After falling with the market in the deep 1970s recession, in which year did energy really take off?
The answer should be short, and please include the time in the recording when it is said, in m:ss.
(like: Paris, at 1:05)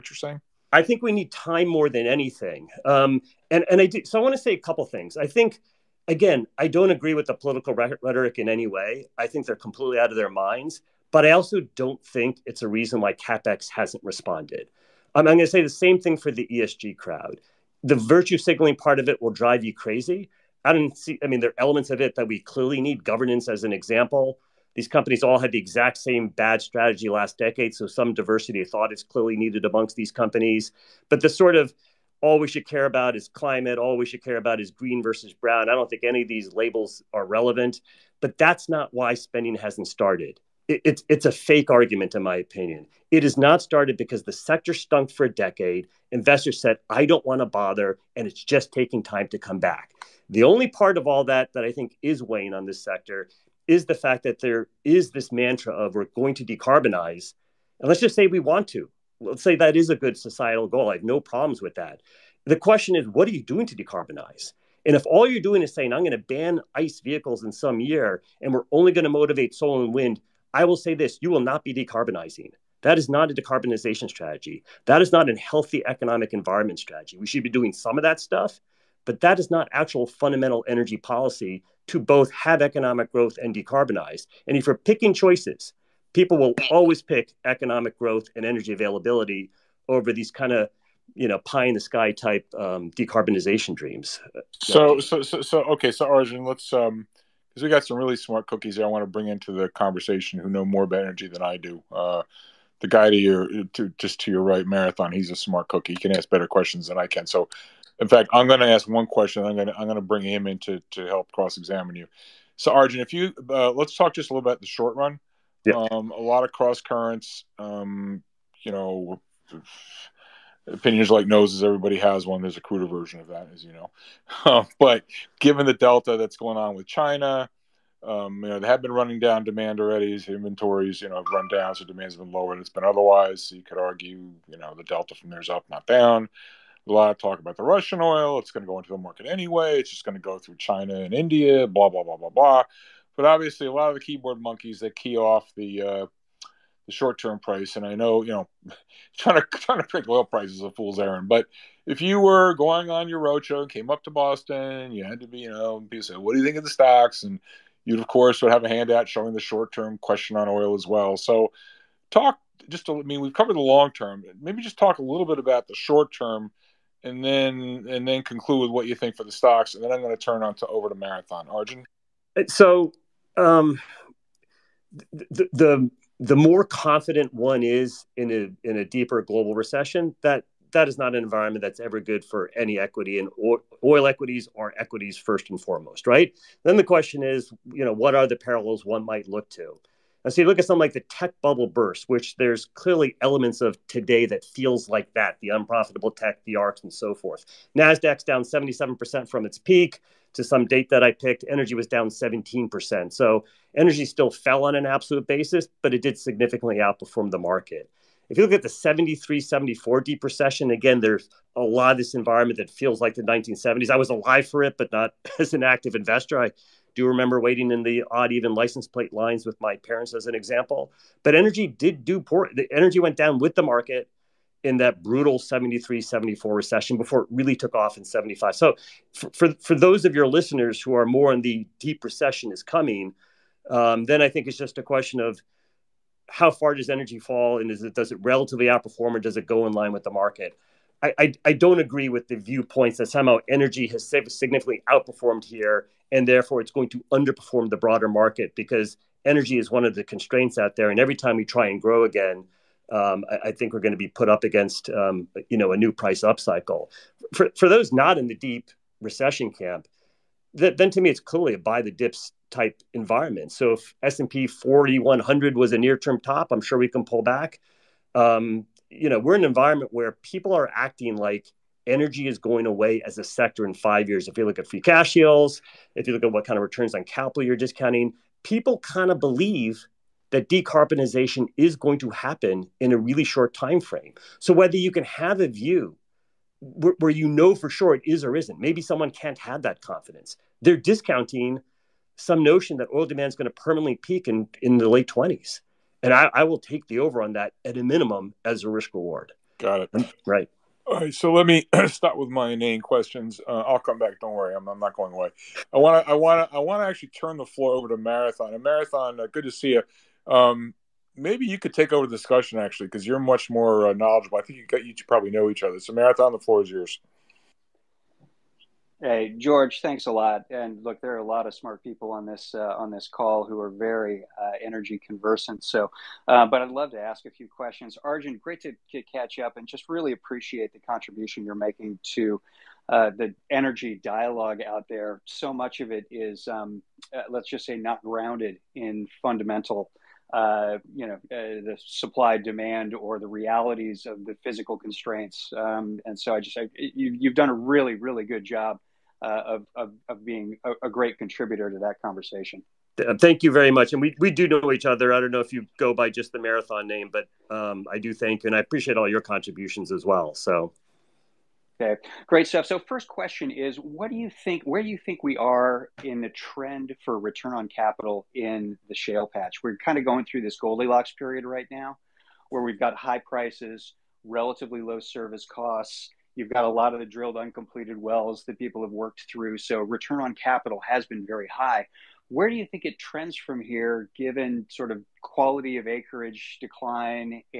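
1975, at 3:48.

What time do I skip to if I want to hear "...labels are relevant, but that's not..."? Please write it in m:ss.
0:36.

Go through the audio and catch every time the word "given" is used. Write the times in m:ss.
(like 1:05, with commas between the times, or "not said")
2:05, 6:24.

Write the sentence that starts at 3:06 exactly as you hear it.
Then the question is, you know, what are the parallels one might look to?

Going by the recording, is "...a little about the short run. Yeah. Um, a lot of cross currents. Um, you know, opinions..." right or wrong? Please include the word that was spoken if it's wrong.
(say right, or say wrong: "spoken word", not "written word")
right.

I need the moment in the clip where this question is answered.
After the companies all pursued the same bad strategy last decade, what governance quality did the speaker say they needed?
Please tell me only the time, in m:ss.
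0:28.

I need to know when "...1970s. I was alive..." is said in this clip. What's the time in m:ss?
3:33.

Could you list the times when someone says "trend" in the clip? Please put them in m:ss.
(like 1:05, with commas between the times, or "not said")
6:06, 6:22.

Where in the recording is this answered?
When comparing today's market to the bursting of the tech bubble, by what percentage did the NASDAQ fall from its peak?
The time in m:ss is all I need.
3:18.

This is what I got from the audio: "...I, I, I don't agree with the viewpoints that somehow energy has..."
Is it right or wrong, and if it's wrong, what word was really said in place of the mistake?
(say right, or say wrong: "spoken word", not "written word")
right.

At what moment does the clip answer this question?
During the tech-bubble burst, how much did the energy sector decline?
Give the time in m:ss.
3:22.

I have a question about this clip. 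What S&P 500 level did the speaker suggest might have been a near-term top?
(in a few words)
4100.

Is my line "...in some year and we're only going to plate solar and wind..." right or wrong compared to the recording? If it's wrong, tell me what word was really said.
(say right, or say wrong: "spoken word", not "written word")
wrong: "motivate", not "plate".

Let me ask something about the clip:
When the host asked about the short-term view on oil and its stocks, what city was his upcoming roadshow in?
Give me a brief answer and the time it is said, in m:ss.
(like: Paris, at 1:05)
Boston, at 2:34.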